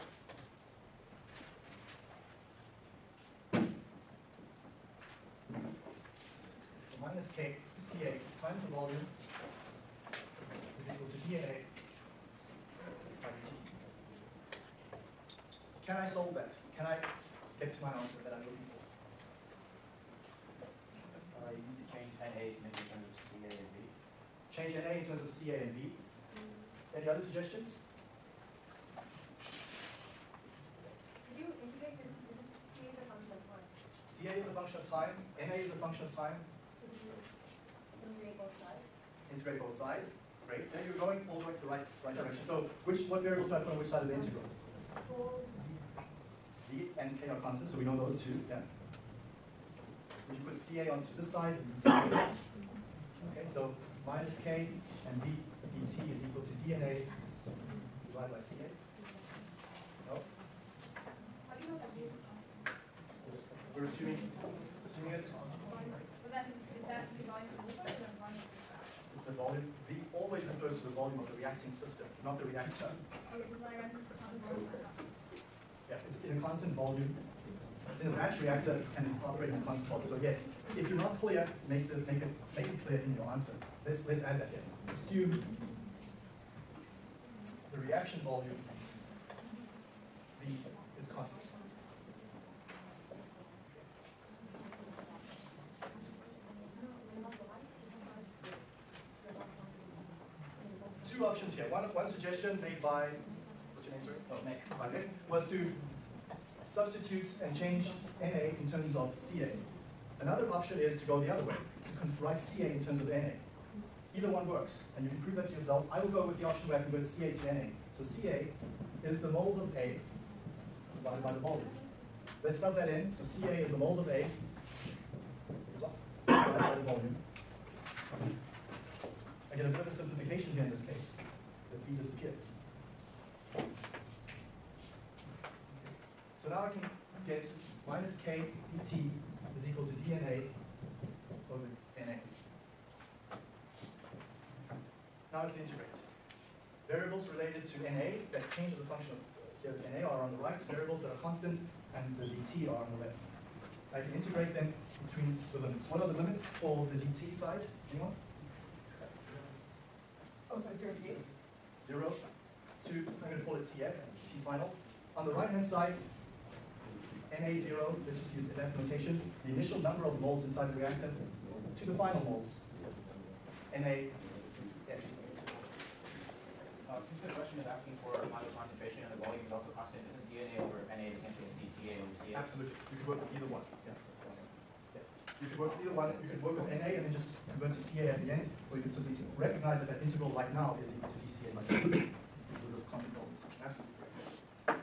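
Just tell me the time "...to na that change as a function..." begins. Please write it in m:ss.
2:27.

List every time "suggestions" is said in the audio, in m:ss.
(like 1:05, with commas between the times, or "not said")
0:27, 1:42.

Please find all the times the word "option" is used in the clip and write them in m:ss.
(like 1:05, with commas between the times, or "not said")
1:41, 1:50, 1:56.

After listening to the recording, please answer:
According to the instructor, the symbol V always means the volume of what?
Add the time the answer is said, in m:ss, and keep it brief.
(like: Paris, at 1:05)
The reacting system, at 1:11.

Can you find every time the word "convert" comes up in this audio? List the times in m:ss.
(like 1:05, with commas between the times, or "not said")
1:56, 3:07.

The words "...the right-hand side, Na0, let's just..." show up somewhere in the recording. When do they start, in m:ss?
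2:45.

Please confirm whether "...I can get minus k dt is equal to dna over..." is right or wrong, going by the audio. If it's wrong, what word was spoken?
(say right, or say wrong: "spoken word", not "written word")
right.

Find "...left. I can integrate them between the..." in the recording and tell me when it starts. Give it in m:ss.
2:33.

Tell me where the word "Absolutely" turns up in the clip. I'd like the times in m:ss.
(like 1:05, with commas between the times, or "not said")
3:02, 3:13.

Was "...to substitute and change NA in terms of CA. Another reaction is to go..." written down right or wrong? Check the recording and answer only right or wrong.
wrong.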